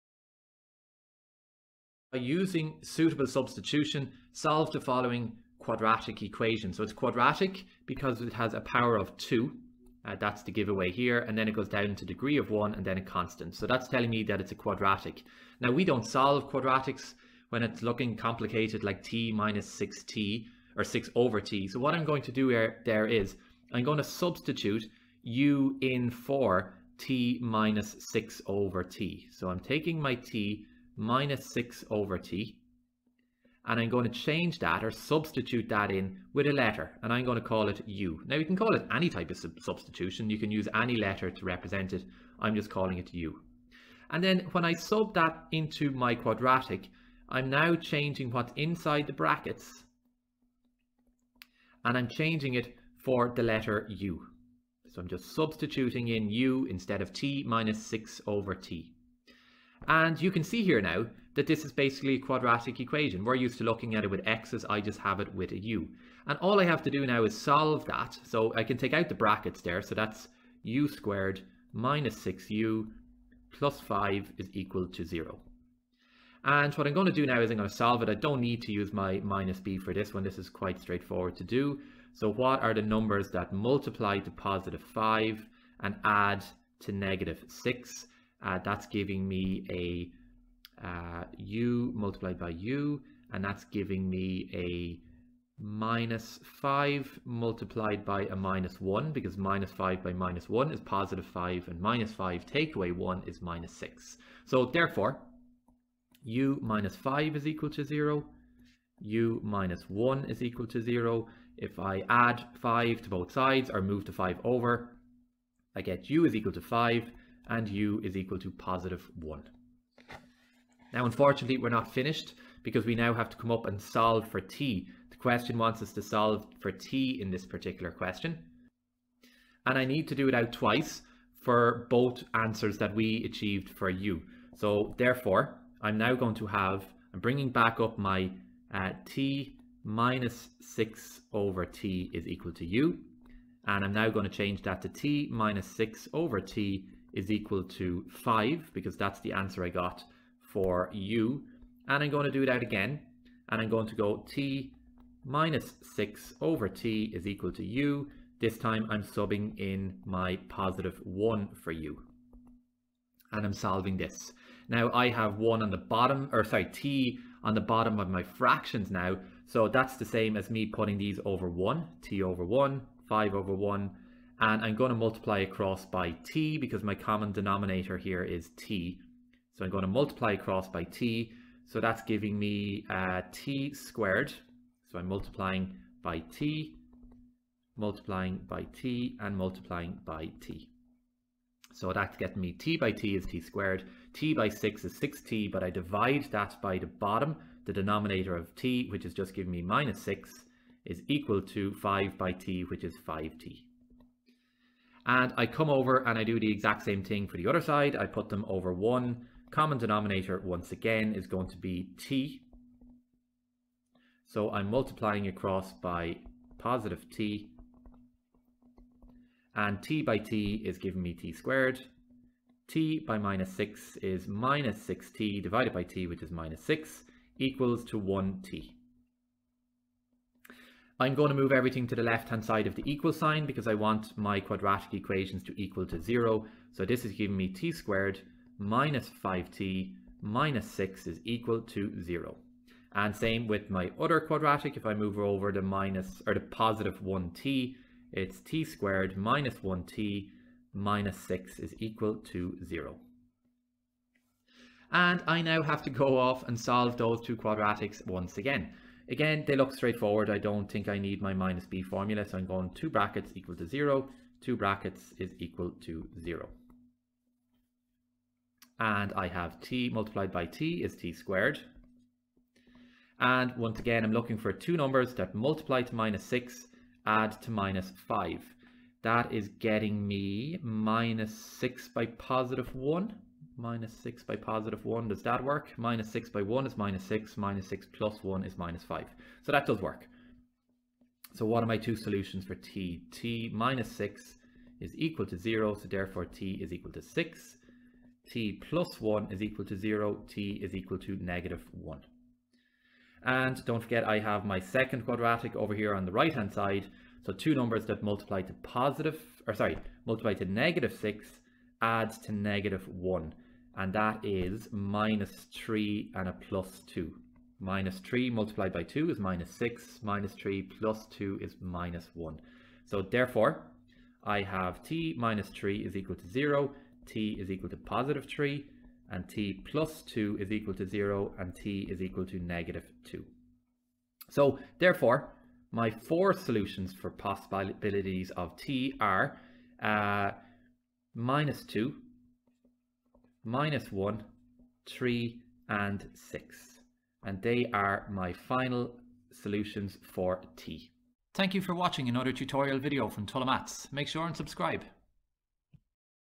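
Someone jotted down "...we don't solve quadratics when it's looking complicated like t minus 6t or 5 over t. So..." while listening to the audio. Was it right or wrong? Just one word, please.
wrong.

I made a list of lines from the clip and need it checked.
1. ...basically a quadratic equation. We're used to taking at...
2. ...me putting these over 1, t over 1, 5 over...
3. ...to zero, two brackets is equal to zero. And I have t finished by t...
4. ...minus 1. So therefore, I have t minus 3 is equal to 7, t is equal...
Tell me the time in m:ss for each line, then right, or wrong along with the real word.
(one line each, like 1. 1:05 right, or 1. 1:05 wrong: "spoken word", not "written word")
1. 1:01 wrong: "looking", not "taking"
2. 2:50 right
3. 4:23 wrong: "multiplied", not "finished"
4. 5:21 wrong: "0", not "7".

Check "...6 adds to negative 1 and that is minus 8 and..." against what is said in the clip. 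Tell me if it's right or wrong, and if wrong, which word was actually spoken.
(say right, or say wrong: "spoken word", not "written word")
wrong: "3", not "8".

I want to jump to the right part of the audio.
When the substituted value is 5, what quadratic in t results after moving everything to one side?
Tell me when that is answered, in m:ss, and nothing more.
3:57.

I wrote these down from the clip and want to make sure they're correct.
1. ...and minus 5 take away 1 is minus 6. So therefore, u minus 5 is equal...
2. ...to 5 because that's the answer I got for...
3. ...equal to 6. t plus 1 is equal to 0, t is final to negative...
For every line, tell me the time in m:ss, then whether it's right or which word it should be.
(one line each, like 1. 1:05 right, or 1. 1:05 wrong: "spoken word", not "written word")
1. 1:41 right
2. 2:27 right
3. 4:56 wrong: "equal", not "final".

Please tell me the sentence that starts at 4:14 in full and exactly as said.
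And I now have to go off and solve those two quadratics once again.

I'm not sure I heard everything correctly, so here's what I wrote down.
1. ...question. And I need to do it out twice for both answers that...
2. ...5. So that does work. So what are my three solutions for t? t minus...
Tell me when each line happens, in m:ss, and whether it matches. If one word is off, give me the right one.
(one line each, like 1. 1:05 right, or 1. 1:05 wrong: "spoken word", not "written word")
1. 2:07 right
2. 4:48 wrong: "two", not "three".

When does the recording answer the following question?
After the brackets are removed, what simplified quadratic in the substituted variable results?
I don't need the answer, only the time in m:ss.
1:10.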